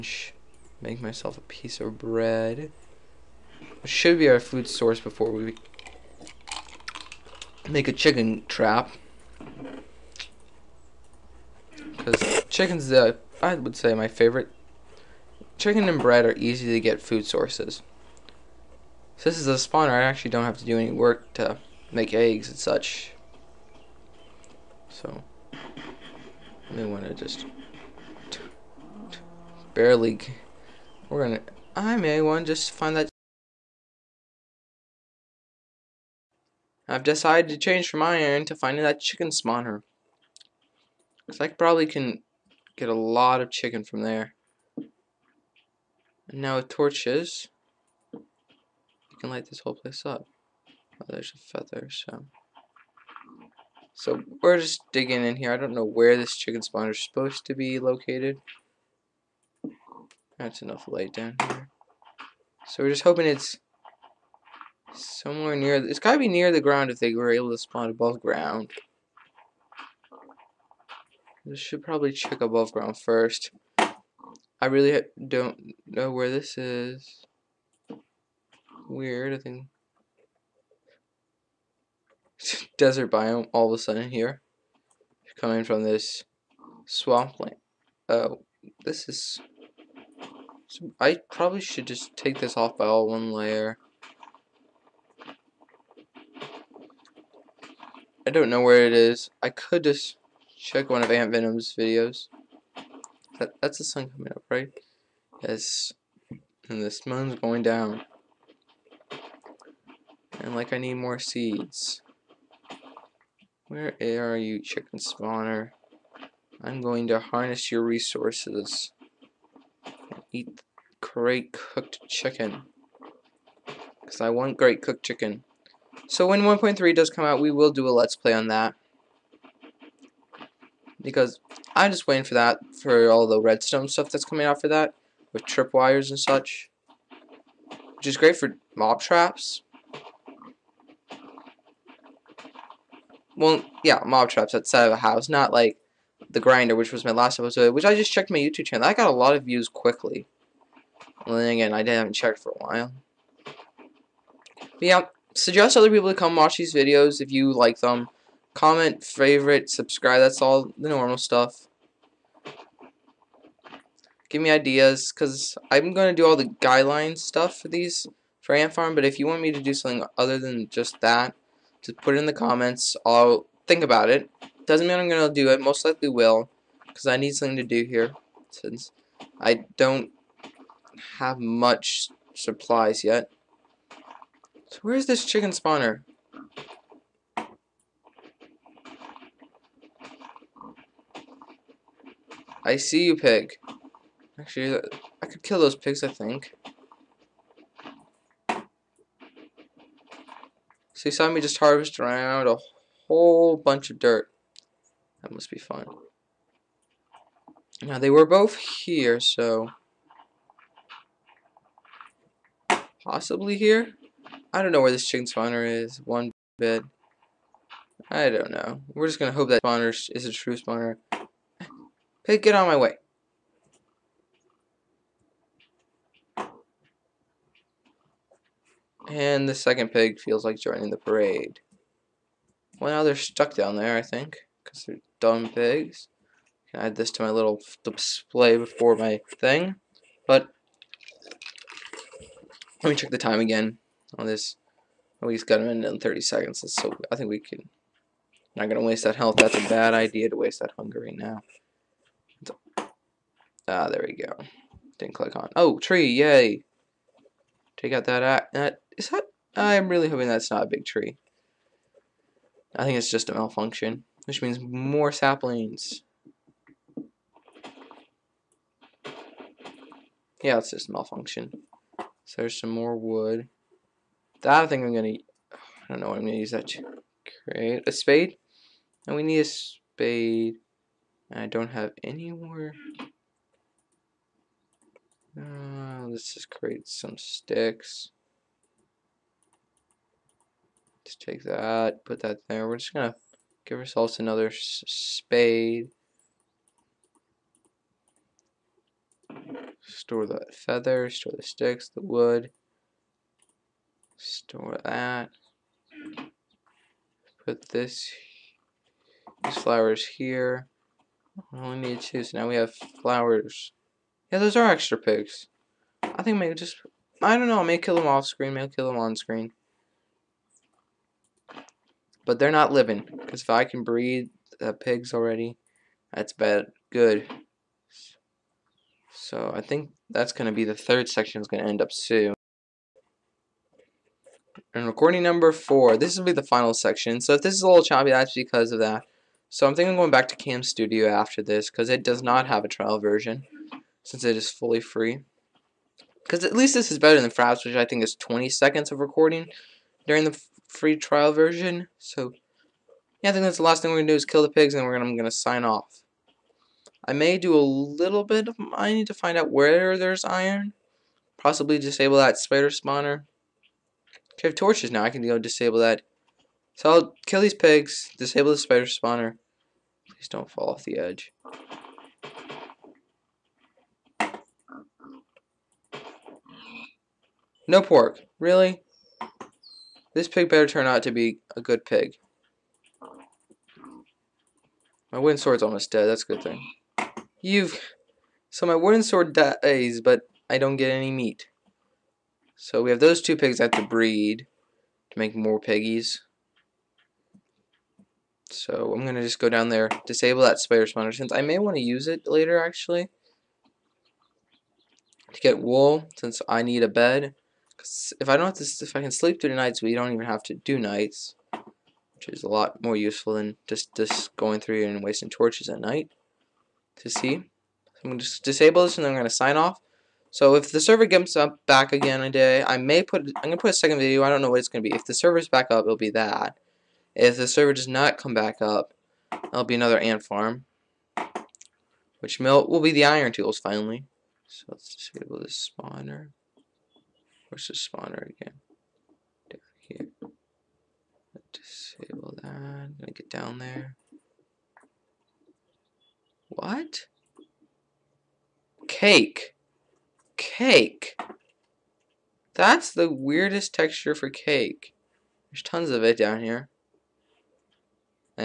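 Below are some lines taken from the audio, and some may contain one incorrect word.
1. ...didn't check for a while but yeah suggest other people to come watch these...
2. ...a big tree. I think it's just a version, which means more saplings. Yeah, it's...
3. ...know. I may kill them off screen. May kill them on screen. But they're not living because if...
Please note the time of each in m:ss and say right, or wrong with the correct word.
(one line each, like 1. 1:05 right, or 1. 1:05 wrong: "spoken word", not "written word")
1. 2:31 right
2. 4:20 wrong: "malfunction", not "version"
3. 5:17 right.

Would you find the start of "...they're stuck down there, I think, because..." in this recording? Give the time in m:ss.
3:53.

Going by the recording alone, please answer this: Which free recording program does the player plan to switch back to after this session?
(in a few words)
Cam Studio.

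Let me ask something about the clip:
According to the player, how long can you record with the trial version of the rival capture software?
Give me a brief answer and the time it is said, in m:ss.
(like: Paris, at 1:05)
20 seconds, at 5:48.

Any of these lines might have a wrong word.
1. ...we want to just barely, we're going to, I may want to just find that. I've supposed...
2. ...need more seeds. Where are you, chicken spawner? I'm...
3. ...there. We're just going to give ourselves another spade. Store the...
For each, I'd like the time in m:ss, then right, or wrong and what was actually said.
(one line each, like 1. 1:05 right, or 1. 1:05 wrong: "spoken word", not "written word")
1. 0:26 wrong: "decided", not "supposed"
2. 1:50 right
3. 4:52 right.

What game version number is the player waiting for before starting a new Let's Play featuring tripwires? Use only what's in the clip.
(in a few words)
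1.3.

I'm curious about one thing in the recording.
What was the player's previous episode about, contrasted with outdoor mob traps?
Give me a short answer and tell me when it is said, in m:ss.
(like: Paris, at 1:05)
the grinder, at 2:26.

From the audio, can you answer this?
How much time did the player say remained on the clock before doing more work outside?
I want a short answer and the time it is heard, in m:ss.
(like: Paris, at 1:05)
1 minute 30 seconds, at 4:05.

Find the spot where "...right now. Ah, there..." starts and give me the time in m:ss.
4:11.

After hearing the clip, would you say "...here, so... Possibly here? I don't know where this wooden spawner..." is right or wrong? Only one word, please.
wrong.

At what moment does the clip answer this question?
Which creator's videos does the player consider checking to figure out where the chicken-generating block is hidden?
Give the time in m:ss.
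1:41.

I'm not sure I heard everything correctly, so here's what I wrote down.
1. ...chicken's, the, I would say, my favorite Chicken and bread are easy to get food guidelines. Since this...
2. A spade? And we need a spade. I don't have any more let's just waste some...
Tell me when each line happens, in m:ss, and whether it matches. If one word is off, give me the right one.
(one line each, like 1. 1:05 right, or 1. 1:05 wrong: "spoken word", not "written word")
1. 0:12 wrong: "sources", not "guidelines"
2. 4:37 wrong: "create", not "waste".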